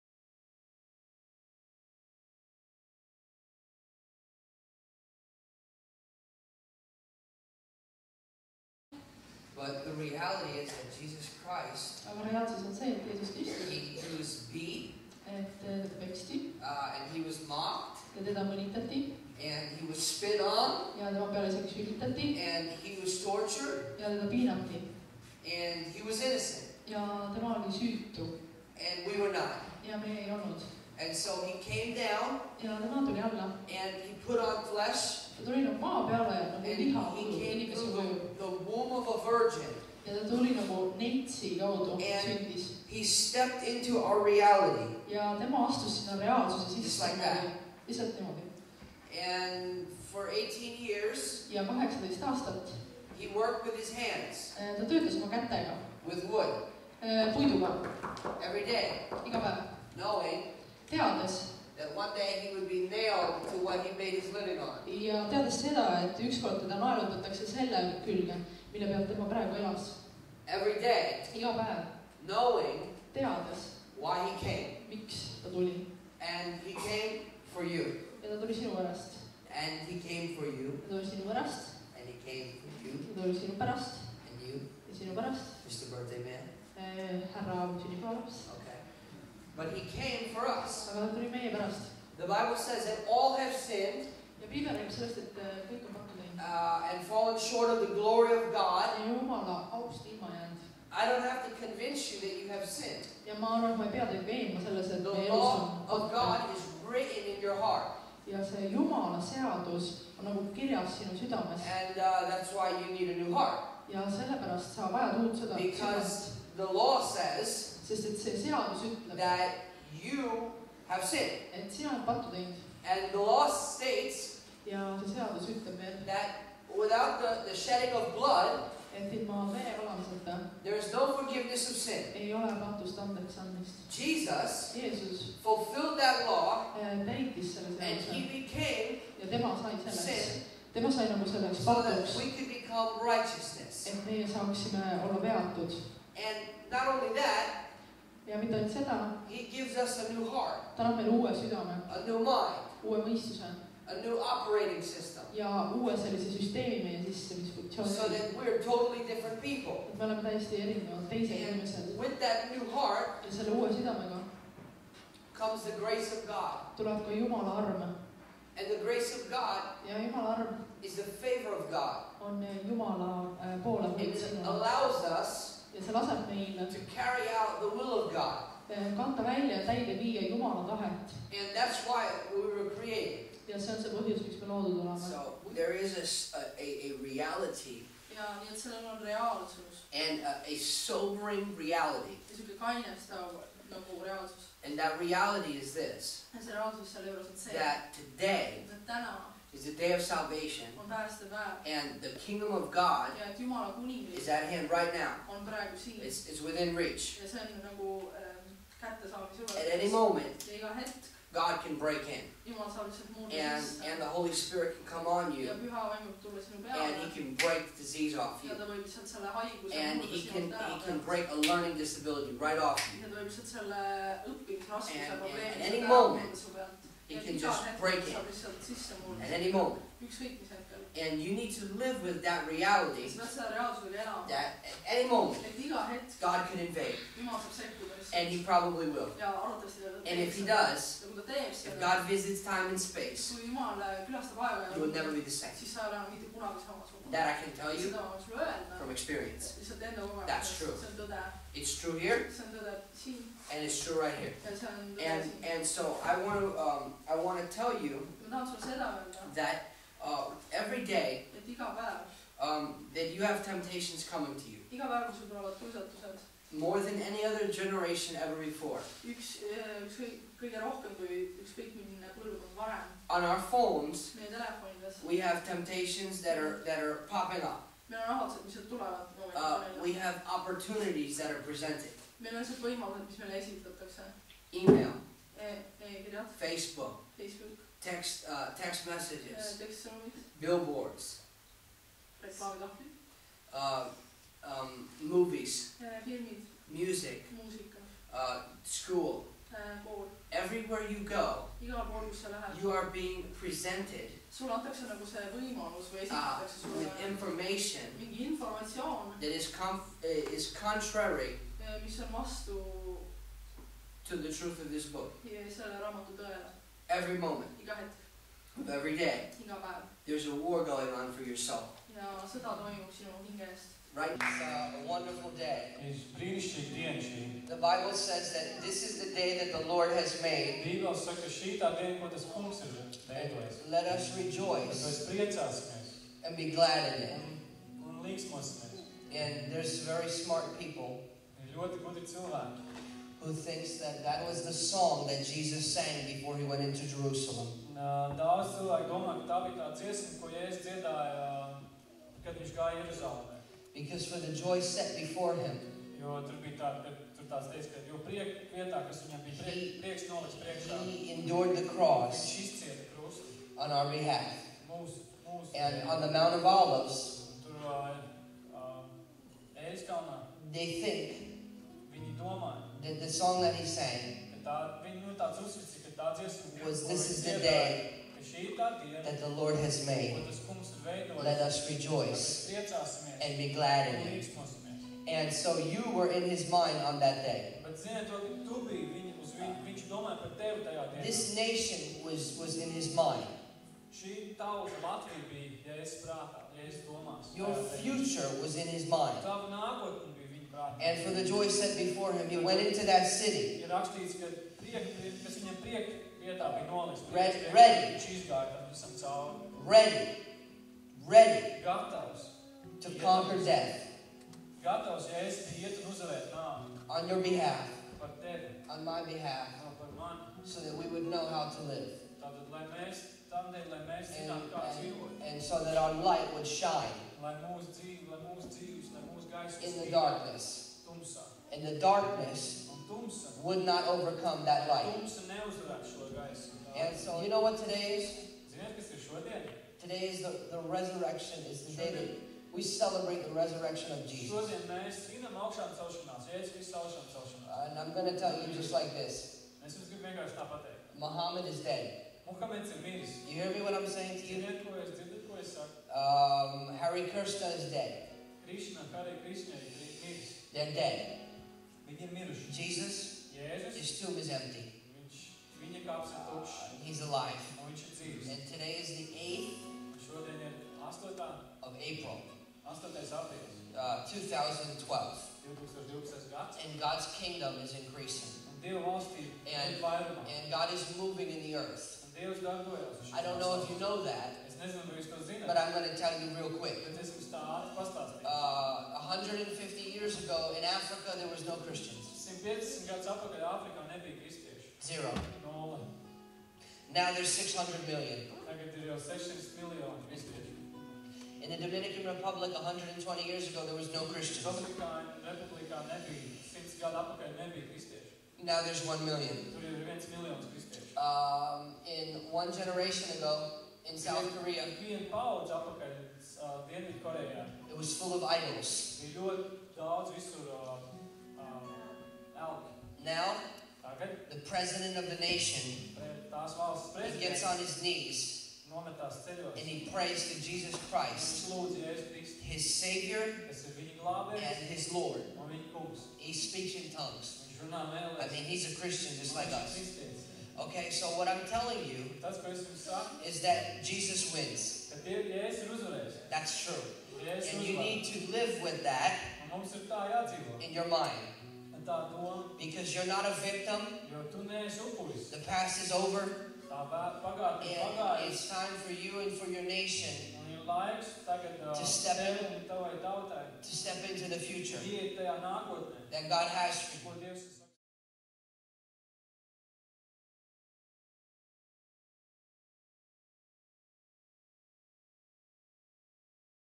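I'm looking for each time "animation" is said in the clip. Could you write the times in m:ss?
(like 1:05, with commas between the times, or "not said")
not said.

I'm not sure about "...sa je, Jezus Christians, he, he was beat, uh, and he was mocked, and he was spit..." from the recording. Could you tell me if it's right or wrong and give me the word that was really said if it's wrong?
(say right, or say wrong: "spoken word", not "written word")
wrong: "Kristus", not "Christians".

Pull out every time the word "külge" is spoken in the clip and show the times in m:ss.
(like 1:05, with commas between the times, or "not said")
1:08.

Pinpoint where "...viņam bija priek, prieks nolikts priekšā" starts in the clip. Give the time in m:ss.
5:59.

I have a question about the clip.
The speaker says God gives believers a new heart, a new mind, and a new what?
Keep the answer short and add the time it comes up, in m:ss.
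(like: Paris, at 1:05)
Operating system, at 2:33.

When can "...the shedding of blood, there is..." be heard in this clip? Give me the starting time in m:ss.
2:07.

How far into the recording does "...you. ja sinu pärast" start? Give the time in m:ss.
1:24.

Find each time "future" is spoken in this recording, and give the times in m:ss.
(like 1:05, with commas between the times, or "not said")
6:37, 9:24.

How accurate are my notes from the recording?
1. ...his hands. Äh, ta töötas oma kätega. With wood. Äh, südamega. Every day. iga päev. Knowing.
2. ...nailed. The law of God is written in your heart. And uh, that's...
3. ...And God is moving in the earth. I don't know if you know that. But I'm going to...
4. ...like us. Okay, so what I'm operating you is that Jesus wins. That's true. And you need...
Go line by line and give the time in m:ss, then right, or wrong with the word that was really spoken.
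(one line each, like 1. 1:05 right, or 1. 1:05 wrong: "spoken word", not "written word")
1. 0:53 wrong: "puiduga", not "südamega"
2. 1:42 wrong: "sinned", not "nailed"
3. 7:59 right
4. 8:59 wrong: "telling", not "operating".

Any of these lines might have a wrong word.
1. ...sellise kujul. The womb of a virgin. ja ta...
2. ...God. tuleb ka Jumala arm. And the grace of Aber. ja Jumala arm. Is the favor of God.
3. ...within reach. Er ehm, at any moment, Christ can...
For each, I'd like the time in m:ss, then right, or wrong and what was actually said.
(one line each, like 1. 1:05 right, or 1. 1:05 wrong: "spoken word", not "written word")
1. 0:37 wrong: "inimese", not "sellise"
2. 2:46 wrong: "God", not "Aber"
3. 3:26 wrong: "God", not "Christ".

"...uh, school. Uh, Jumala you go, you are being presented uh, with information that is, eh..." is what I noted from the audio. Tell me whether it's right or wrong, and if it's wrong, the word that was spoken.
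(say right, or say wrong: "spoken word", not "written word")
wrong: "Everywhere", not "Jumala".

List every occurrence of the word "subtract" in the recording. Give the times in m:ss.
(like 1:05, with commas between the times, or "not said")
not said.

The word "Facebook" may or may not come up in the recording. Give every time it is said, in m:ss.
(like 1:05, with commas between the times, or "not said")
4:46.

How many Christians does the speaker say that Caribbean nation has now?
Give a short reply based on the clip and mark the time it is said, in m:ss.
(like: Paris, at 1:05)
1 million, at 8:28.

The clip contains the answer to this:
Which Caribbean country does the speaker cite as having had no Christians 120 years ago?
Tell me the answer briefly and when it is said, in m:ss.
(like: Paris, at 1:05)
Dominican Republic, at 8:21.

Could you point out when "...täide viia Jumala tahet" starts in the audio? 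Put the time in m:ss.
2:59.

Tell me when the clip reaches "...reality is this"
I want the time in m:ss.
3:14.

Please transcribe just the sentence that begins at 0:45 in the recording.
ja tema astus sinna reaalsuse sisse.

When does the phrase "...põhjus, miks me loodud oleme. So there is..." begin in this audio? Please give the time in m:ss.
3:03.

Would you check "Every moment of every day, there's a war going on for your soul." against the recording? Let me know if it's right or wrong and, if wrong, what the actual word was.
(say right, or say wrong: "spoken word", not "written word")
right.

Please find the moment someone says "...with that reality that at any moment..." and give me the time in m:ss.
3:52.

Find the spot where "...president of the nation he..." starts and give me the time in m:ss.
8:44.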